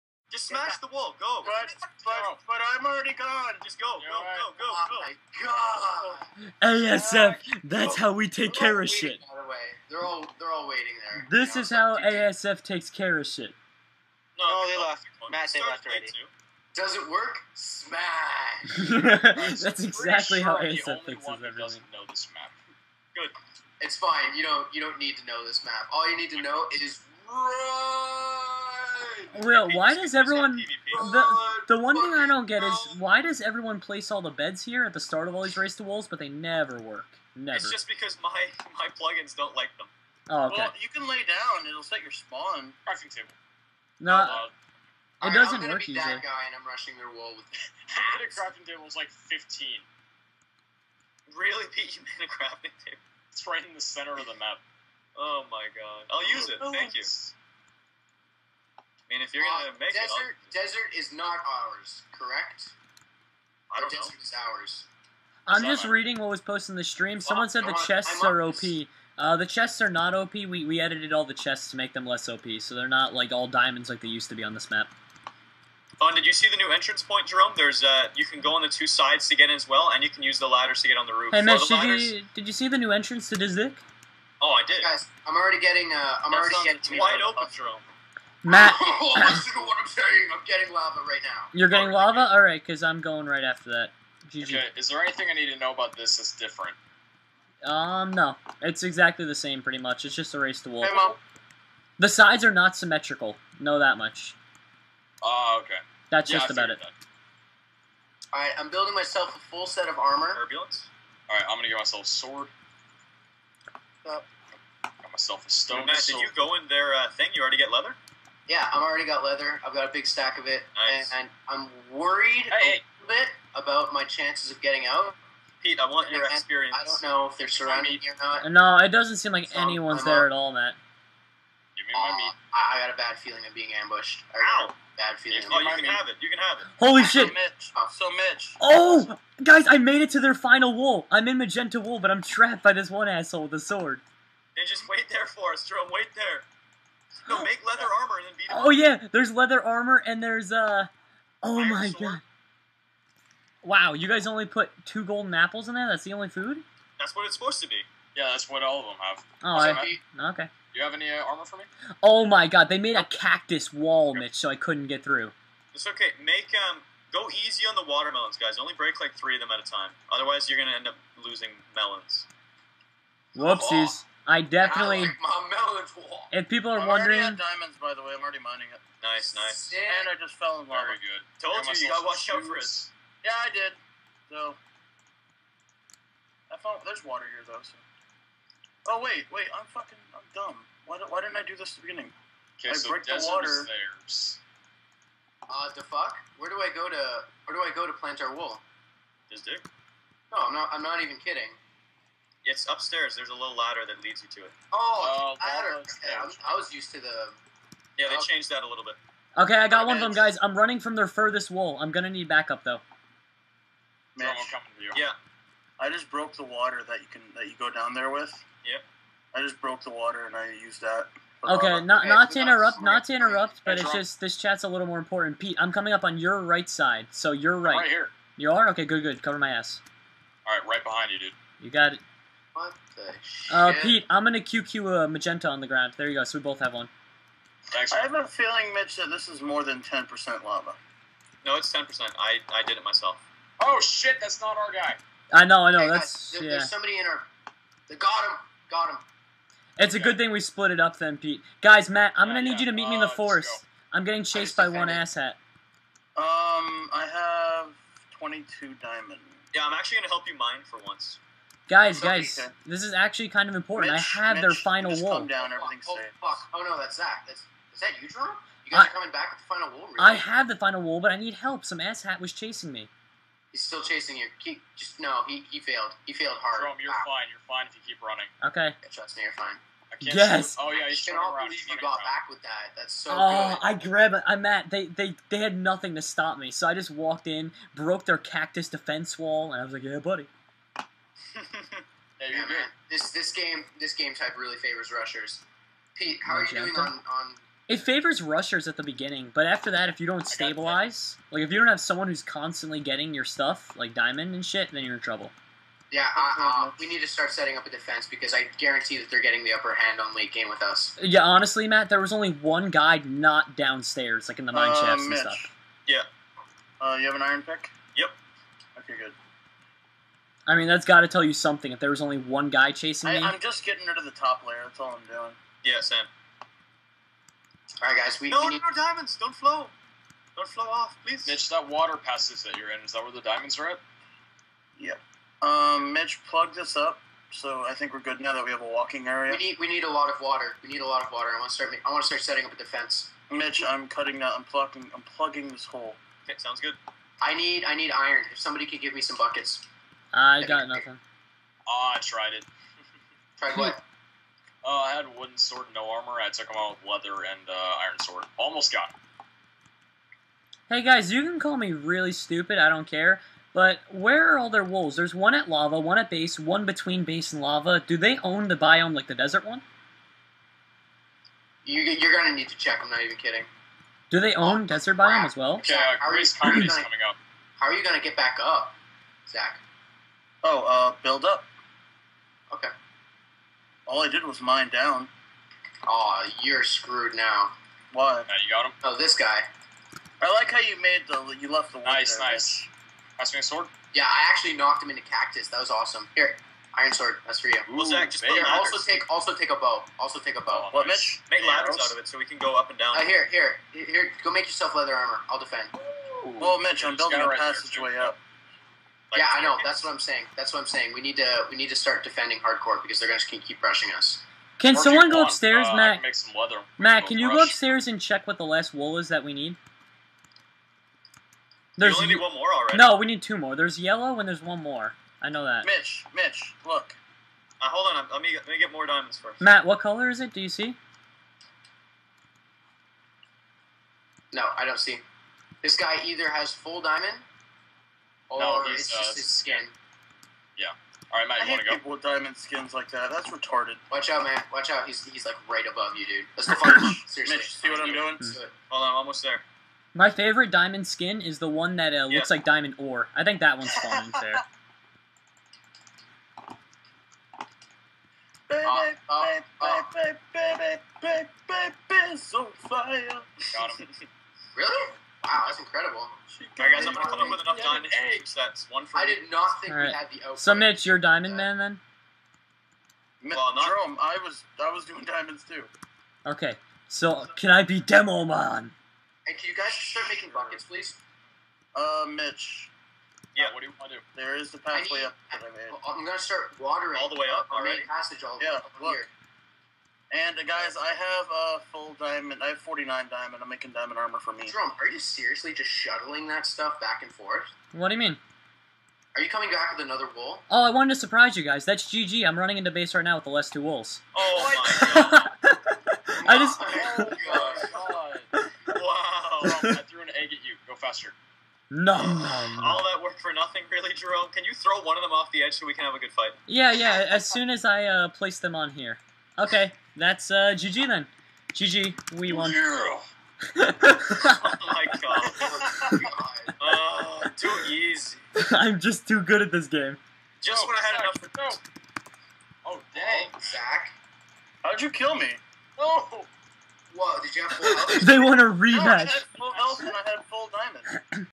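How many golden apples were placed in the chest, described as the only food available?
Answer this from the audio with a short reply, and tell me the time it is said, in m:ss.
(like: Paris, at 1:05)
2, at 2:34.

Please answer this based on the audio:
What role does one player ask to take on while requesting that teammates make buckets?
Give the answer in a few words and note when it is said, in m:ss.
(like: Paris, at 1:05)
Demo Man, at 7:57.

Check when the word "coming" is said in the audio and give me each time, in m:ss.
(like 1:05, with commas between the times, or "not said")
3:34, 3:45, 4:28, 6:16, 8:19.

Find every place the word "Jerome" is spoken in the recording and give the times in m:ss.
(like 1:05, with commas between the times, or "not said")
1:17, 1:27, 2:25, 4:36, 7:53, 8:14, 8:33.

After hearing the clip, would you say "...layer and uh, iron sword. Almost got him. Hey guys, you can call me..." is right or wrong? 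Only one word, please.
wrong.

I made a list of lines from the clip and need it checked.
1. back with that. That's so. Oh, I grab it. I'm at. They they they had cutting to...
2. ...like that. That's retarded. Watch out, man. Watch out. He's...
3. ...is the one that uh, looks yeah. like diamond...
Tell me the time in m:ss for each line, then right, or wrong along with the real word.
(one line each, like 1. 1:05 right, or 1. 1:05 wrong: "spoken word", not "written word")
1. 4:42 wrong: "nothing", not "cutting"
2. 7:22 right
3. 7:31 right.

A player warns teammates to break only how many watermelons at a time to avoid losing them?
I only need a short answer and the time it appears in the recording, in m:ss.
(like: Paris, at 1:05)
3, at 2:49.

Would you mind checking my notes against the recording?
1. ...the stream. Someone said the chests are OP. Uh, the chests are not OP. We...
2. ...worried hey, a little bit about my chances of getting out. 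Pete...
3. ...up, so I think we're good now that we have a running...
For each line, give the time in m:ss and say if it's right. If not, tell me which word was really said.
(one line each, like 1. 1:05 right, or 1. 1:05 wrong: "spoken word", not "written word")
1. 1:06 right
2. 2:01 right
3. 5:36 wrong: "walking", not "running".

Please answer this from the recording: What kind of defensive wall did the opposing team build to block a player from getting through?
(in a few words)
Cactus wall.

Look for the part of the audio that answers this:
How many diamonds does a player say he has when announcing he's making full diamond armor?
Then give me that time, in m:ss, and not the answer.
8:12.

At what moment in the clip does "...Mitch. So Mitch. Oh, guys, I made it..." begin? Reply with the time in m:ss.
2:17.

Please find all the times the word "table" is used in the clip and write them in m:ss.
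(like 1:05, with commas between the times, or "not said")
0:43, 0:48, 0:52.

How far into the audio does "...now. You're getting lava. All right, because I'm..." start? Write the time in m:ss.
1:31.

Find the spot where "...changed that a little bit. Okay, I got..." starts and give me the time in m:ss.
3:28.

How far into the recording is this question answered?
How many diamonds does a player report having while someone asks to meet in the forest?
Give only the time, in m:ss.
4:18.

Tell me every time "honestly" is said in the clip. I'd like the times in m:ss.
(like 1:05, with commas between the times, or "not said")
5:11.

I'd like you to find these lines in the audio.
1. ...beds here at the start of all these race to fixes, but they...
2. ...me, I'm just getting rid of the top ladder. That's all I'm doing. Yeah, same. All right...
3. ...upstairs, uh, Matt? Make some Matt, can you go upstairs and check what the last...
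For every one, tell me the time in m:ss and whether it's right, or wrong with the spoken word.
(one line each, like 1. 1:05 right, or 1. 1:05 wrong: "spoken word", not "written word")
1. 0:34 wrong: "wolves", not "fixes"
2. 5:23 wrong: "layer", not "ladder"
3. 6:55 right.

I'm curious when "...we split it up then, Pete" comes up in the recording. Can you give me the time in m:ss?
4:10.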